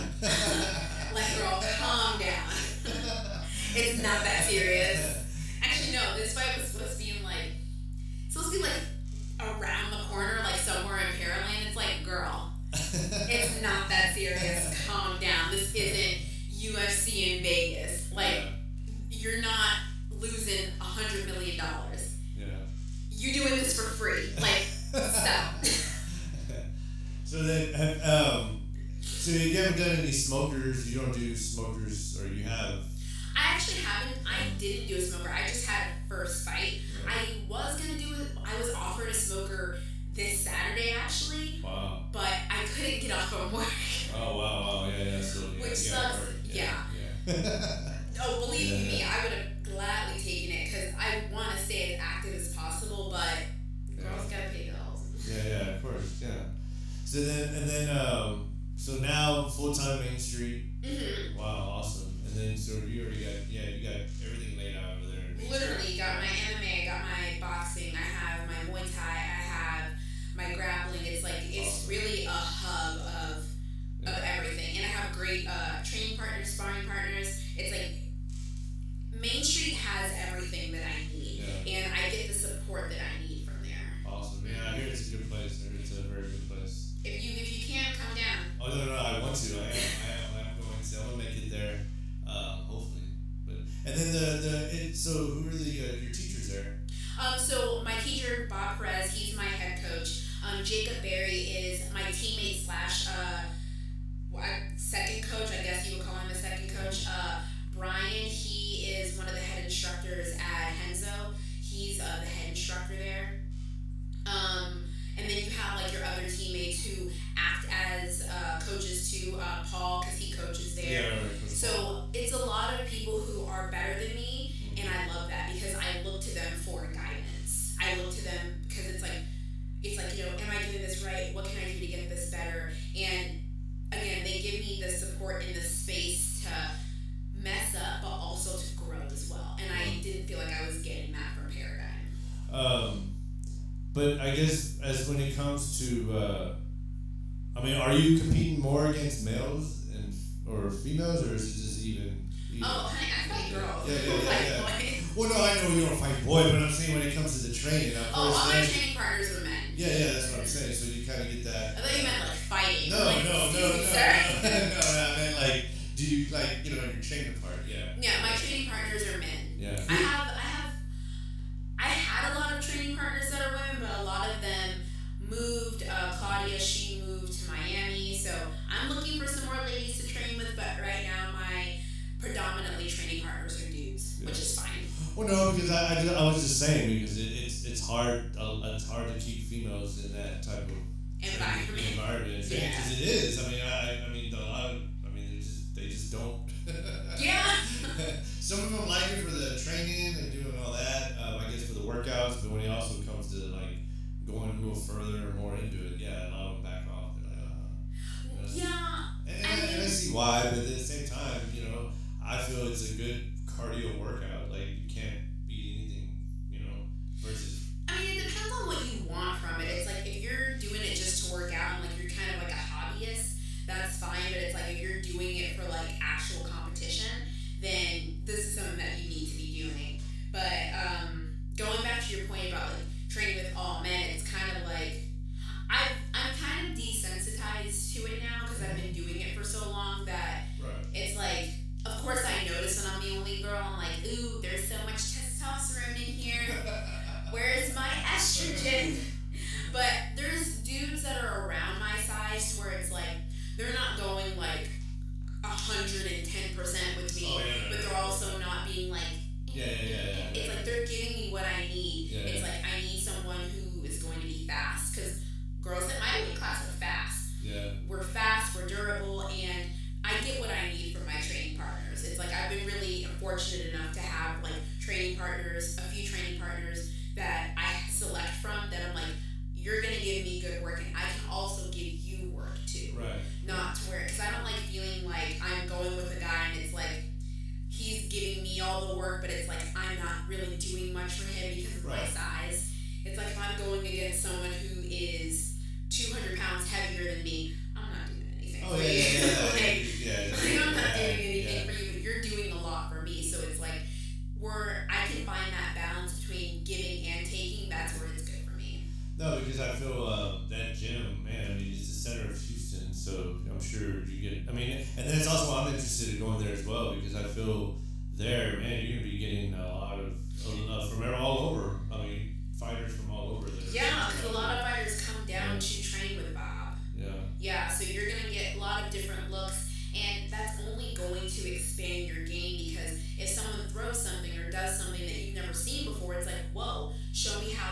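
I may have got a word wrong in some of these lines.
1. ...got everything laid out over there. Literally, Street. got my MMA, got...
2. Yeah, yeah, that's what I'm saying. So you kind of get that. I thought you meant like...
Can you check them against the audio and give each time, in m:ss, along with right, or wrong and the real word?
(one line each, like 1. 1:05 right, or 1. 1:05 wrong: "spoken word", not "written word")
1. 1:03 right
2. 2:39 right.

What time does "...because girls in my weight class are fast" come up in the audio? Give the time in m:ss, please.
4:24.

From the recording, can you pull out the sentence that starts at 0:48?
me, I would have gladly taken it because I want to stay as active as possible, but yeah.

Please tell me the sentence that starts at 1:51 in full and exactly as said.
He's uh, the head instructor there.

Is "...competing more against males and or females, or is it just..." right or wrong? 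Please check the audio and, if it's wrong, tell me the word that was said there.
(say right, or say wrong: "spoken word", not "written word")
right.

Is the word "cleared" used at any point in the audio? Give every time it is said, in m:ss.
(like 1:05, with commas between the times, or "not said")
not said.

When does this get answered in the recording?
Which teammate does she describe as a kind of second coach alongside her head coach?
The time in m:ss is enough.
1:40.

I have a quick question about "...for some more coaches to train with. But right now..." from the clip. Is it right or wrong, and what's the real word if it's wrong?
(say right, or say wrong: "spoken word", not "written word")
wrong: "ladies", not "coaches".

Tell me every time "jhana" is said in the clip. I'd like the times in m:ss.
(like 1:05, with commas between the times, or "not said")
not said.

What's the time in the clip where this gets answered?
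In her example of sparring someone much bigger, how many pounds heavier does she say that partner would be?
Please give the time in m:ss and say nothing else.
4:55.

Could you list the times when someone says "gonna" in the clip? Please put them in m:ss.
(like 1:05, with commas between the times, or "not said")
5:18, 5:28.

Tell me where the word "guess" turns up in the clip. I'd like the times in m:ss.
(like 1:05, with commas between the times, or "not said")
1:45, 2:24, 3:21.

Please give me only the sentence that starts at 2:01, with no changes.
Yeah, so it's a lot of people who are better than me, mm-hmm.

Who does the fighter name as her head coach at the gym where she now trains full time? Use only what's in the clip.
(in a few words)
Bob Perez.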